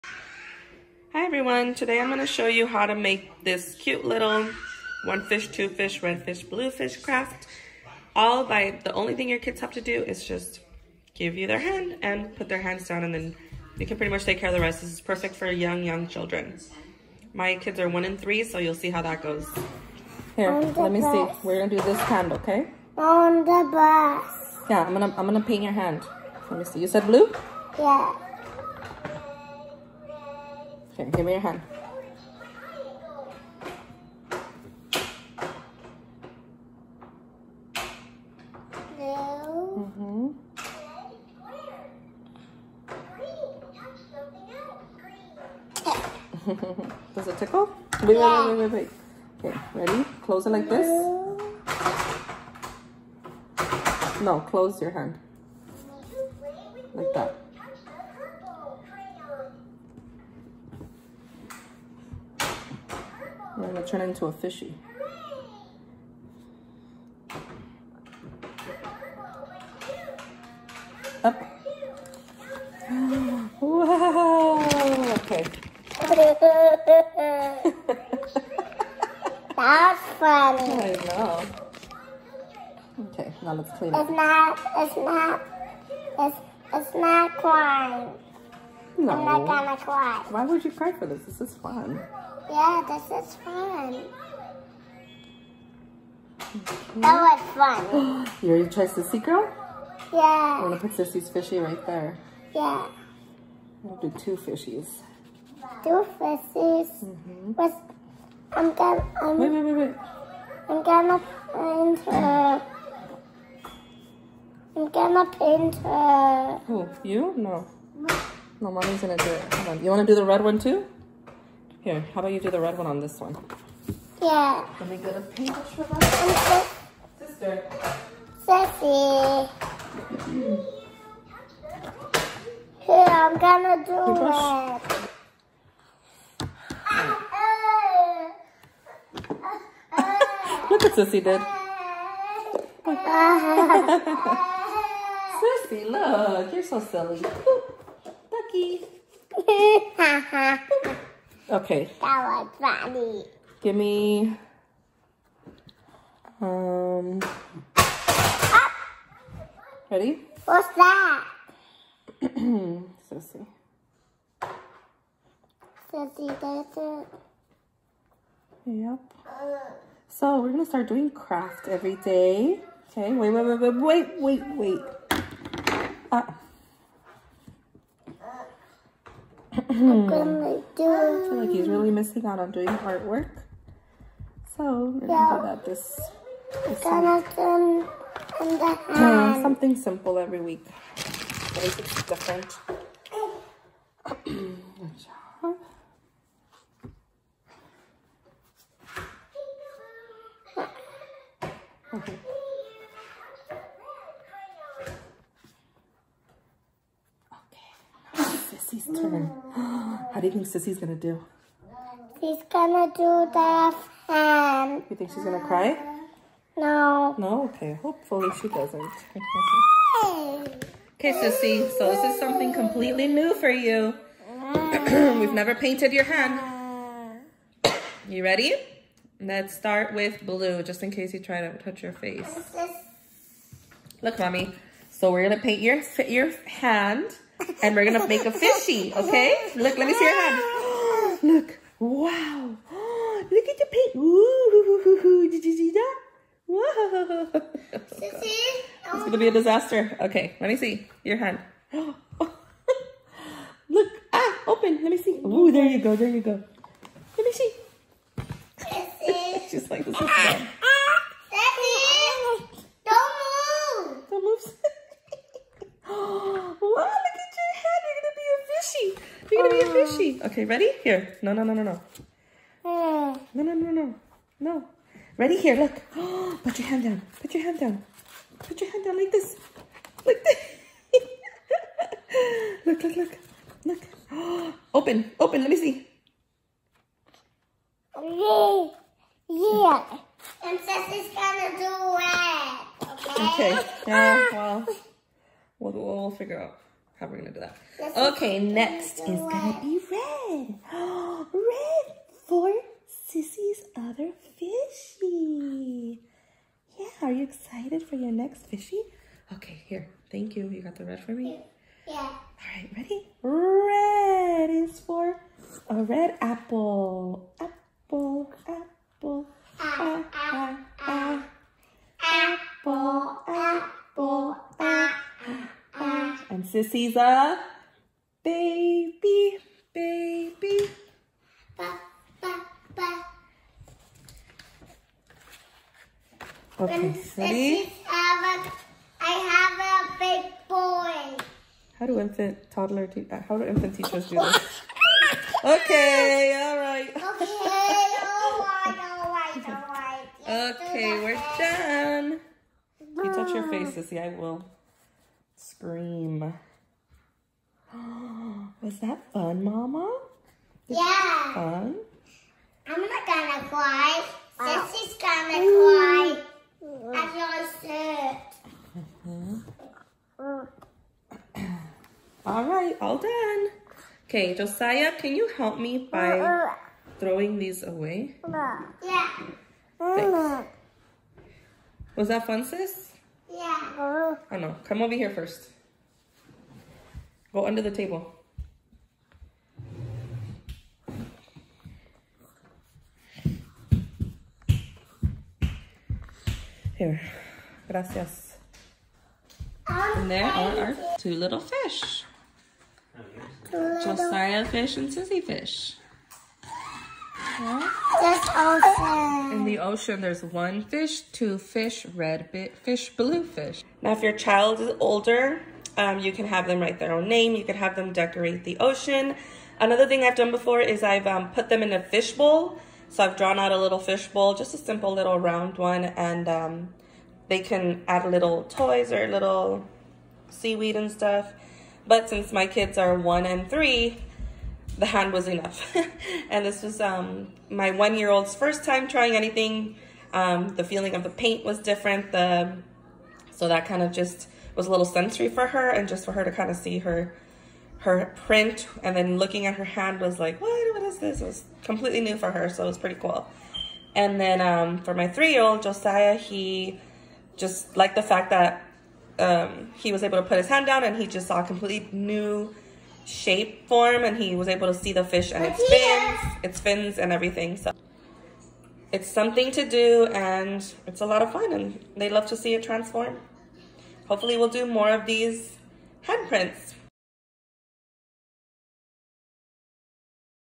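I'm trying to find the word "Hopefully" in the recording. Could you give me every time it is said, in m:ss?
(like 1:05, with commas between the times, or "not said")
3:37, 7:54.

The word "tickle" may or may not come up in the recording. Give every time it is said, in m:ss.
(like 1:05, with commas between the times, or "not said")
0:47.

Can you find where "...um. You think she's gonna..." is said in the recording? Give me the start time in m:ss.
3:34.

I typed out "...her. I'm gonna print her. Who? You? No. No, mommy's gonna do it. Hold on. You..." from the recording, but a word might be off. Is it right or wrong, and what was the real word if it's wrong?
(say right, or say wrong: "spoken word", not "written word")
wrong: "paint", not "print".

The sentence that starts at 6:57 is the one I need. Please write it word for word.
You could have them decorate the ocean.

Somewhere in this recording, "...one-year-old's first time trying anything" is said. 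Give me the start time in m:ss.
7:17.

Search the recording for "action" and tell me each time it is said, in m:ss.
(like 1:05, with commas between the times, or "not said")
not said.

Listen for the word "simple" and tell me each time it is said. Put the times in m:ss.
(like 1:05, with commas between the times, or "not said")
3:09, 7:04.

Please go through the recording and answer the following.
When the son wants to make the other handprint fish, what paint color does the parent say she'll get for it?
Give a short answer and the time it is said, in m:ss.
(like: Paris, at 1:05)
pink, at 2:05.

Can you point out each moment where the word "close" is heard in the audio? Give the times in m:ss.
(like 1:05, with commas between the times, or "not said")
0:50, 0:54.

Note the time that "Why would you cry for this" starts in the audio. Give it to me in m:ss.
1:30.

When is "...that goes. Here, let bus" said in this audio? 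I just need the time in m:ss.
0:19.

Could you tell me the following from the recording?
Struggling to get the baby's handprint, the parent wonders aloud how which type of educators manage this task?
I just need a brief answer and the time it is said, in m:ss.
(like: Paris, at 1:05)
infant teachers, at 5:43.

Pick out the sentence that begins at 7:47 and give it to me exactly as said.
So it's something to do and it's a lot of fun and they love to see it transform.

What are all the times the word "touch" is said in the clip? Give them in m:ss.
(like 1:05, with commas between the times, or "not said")
3:51, 5:53.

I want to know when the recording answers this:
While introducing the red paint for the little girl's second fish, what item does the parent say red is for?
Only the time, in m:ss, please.
5:15.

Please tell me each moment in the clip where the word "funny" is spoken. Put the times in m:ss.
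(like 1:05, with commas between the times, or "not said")
1:20, 2:32.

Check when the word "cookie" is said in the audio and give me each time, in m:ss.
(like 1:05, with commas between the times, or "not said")
2:28.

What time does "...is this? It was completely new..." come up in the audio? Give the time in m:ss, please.
7:30.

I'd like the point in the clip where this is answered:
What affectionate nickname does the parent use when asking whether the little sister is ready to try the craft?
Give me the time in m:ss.
1:38.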